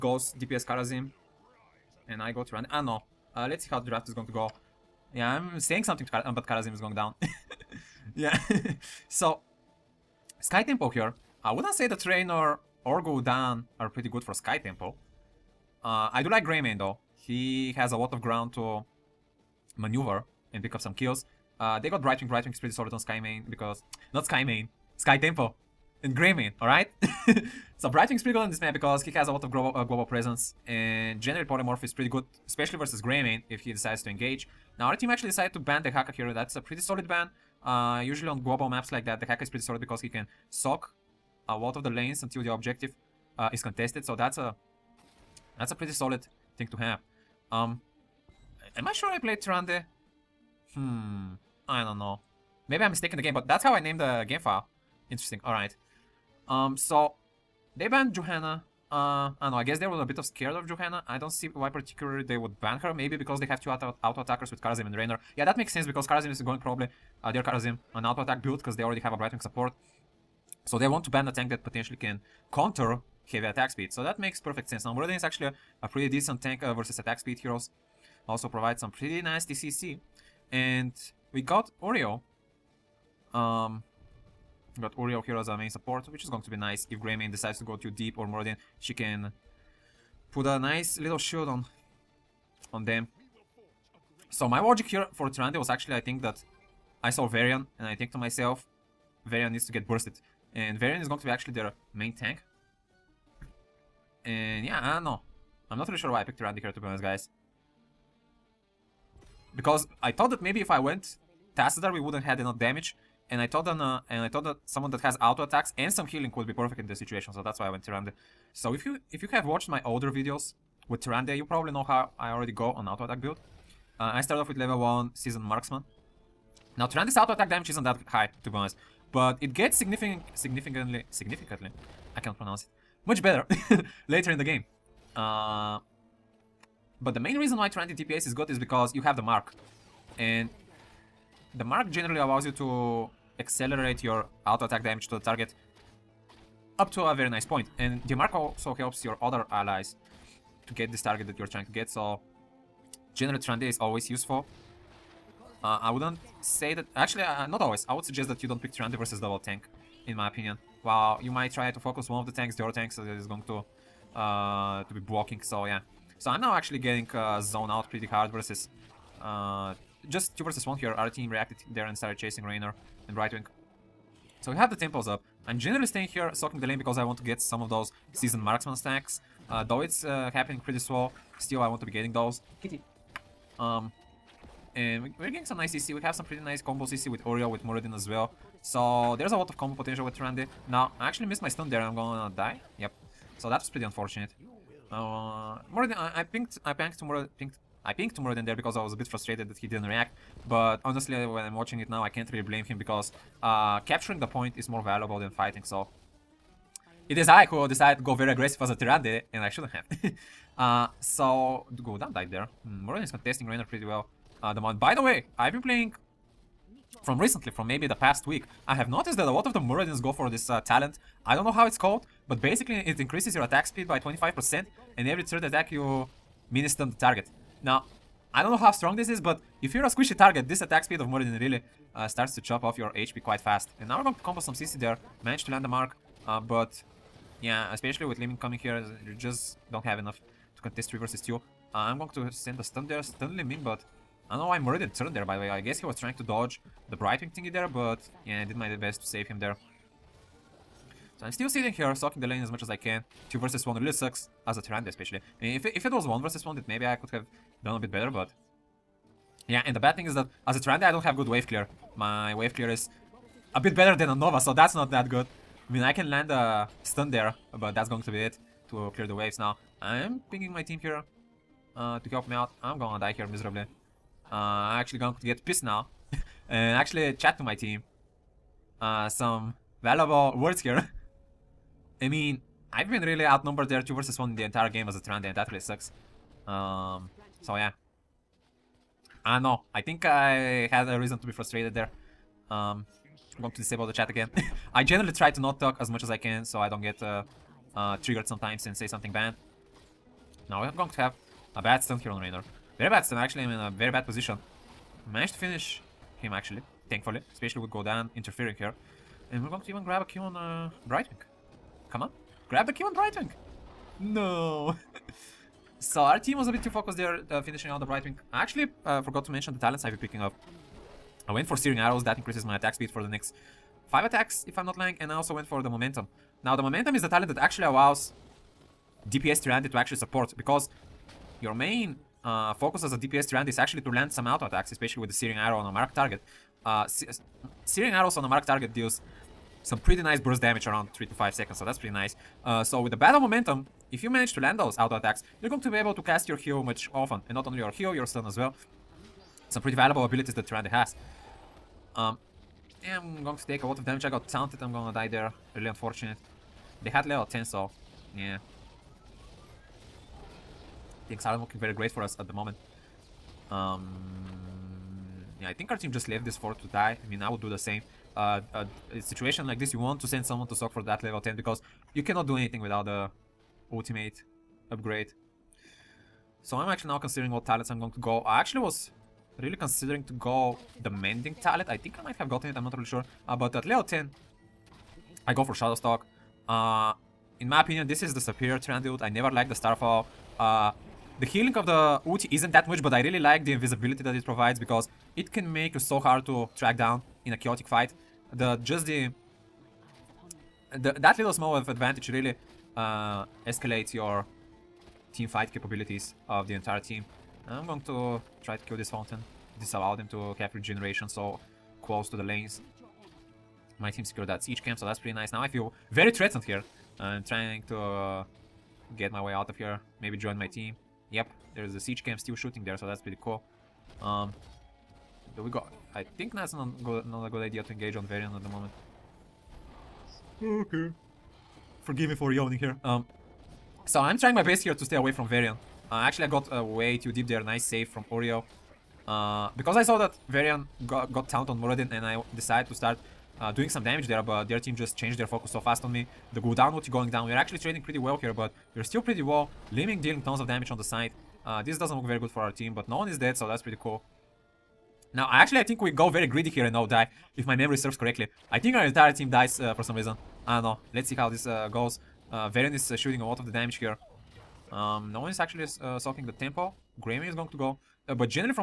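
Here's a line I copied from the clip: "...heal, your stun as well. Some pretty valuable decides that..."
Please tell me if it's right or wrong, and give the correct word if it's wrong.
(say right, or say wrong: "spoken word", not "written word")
wrong: "abilities", not "decides".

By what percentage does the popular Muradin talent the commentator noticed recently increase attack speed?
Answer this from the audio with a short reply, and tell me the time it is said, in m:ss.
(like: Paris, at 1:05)
25%, at 3:43.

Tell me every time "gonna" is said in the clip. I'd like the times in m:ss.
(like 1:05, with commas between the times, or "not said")
3:11, 4:32, 5:54.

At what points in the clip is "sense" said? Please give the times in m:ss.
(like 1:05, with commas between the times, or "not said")
1:05, 1:14.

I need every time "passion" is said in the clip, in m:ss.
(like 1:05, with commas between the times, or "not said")
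not said.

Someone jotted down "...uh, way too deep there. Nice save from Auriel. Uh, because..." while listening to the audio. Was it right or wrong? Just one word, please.
right.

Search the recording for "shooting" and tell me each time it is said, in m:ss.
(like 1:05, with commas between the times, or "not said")
7:02, 7:42.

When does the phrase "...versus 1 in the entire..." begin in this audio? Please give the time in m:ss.
4:43.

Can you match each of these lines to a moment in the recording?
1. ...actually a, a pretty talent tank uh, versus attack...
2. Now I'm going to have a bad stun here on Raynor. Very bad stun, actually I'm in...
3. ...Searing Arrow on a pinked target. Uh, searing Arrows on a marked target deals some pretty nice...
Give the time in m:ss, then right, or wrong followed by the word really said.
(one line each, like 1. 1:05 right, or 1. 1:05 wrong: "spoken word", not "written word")
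1. 1:15 wrong: "decent", not "talent"
2. 5:00 right
3. 5:35 wrong: "marked", not "pinked".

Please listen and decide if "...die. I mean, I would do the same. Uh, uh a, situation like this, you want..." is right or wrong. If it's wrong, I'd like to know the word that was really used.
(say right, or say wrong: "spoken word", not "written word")
right.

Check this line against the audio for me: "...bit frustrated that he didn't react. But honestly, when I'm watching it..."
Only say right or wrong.
right.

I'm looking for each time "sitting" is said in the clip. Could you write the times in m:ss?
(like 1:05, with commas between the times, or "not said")
4:11.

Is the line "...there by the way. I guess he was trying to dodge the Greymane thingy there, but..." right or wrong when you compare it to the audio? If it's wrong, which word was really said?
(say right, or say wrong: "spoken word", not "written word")
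wrong: "Brightwing", not "Greymane".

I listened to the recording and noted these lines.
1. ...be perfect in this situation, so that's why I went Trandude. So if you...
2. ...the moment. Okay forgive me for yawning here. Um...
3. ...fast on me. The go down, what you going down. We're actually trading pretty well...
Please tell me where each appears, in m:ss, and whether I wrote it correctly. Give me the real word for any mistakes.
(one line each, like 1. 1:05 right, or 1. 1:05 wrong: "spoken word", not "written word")
1. 1:56 wrong: "Tyrande", not "Trandude"
2. 7:08 right
3. 7:25 right.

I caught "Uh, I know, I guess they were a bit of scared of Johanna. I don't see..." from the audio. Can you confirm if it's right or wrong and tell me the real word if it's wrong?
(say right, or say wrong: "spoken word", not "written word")
right.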